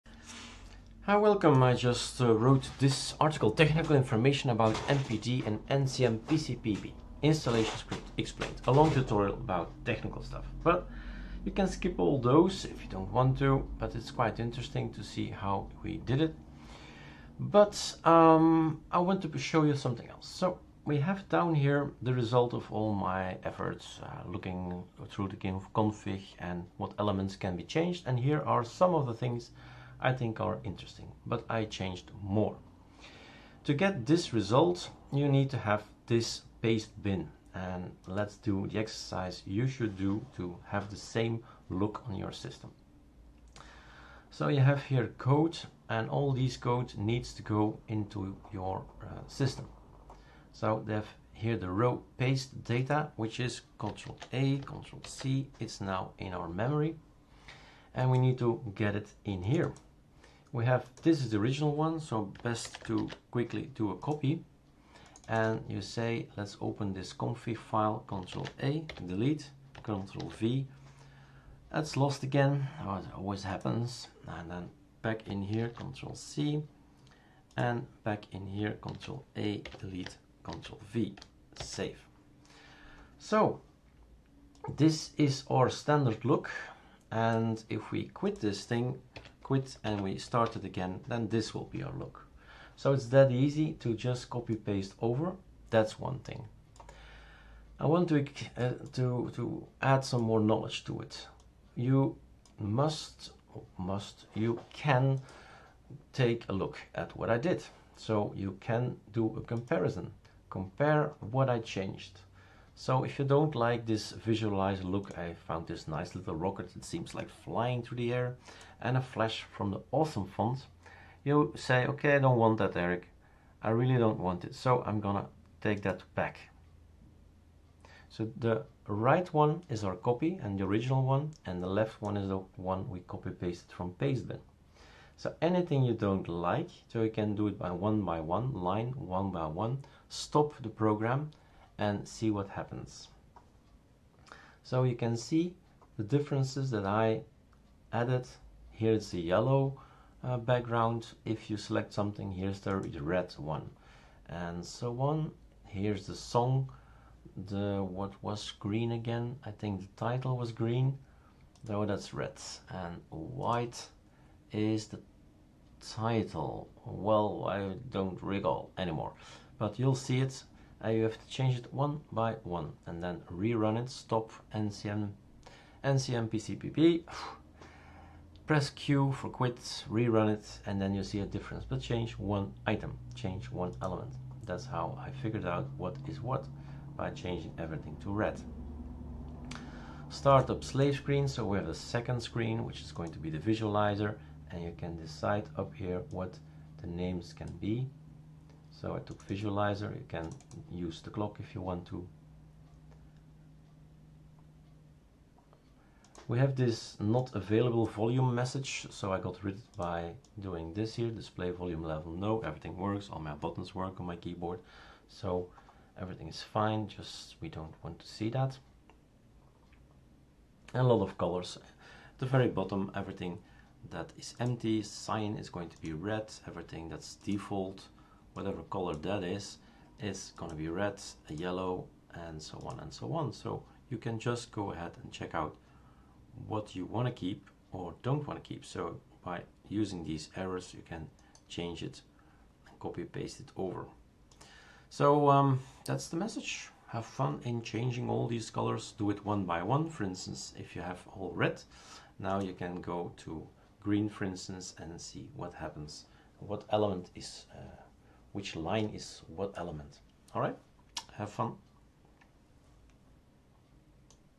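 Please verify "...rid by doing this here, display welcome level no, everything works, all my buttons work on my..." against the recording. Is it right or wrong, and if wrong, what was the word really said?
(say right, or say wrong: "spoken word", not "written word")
wrong: "volume", not "welcome".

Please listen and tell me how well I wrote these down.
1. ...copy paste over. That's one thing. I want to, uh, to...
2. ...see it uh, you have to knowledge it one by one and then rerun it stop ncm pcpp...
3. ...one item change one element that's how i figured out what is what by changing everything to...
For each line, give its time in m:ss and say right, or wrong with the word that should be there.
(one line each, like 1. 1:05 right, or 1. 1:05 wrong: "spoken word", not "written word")
1. 1:34 right
2. 2:50 wrong: "change", not "knowledge"
3. 3:02 right.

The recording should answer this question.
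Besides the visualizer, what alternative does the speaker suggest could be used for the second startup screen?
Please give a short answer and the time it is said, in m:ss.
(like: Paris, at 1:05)
The clock, at 3:21.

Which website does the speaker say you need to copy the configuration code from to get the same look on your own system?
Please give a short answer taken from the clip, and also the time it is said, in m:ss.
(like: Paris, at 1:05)
Pastebin, at 0:36.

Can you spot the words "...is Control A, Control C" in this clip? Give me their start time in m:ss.
0:53.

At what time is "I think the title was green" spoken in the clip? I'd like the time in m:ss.
2:39.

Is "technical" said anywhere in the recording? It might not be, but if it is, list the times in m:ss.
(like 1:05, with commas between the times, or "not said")
0:03, 0:09.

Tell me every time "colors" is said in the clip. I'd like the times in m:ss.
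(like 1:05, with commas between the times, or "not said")
3:41, 3:48, 4:08.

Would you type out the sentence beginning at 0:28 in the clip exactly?
And here are some of the things I think are interesting, but I changed more.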